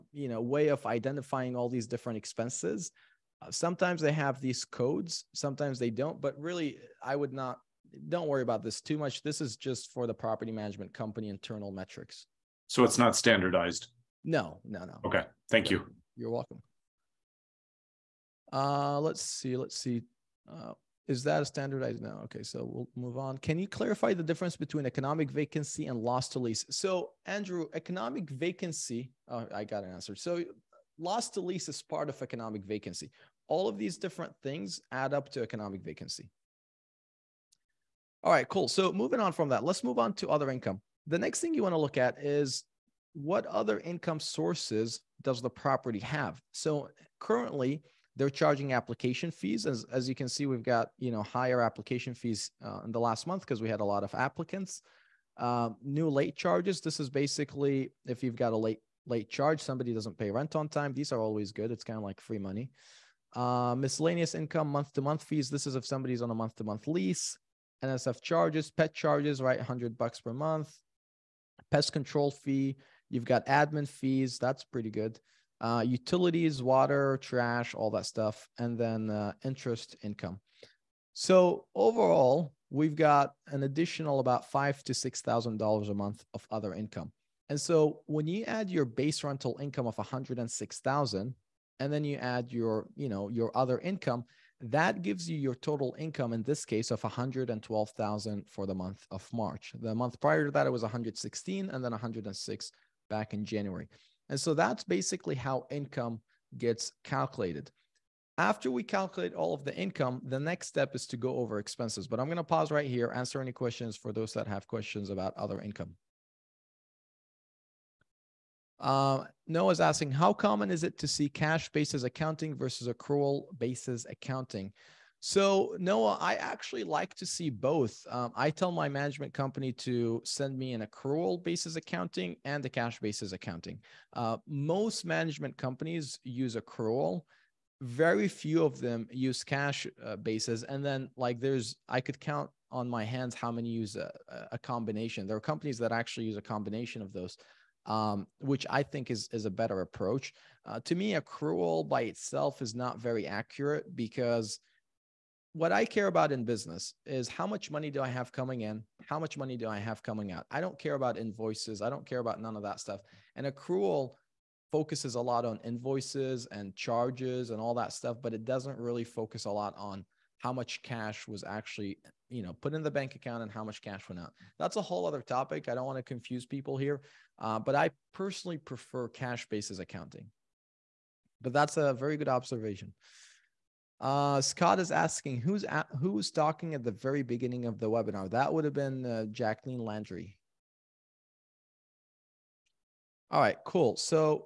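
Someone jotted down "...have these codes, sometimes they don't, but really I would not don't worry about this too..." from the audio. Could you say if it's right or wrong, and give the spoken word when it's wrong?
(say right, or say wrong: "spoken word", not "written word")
right.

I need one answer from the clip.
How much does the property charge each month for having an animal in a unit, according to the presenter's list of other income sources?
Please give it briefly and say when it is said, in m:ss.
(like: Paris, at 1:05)
$100, at 1:09.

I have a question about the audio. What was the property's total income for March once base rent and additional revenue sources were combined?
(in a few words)
112,000.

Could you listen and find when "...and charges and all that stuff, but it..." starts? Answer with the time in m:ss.
2:46.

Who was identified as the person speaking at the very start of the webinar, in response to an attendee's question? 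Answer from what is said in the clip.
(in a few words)
Jacqueline Landry.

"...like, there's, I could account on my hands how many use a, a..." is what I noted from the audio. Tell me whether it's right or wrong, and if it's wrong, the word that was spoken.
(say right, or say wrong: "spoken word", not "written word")
wrong: "count", not "account".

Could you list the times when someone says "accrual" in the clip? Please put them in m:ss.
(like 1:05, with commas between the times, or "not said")
2:02, 2:10, 2:16, 2:31, 2:43.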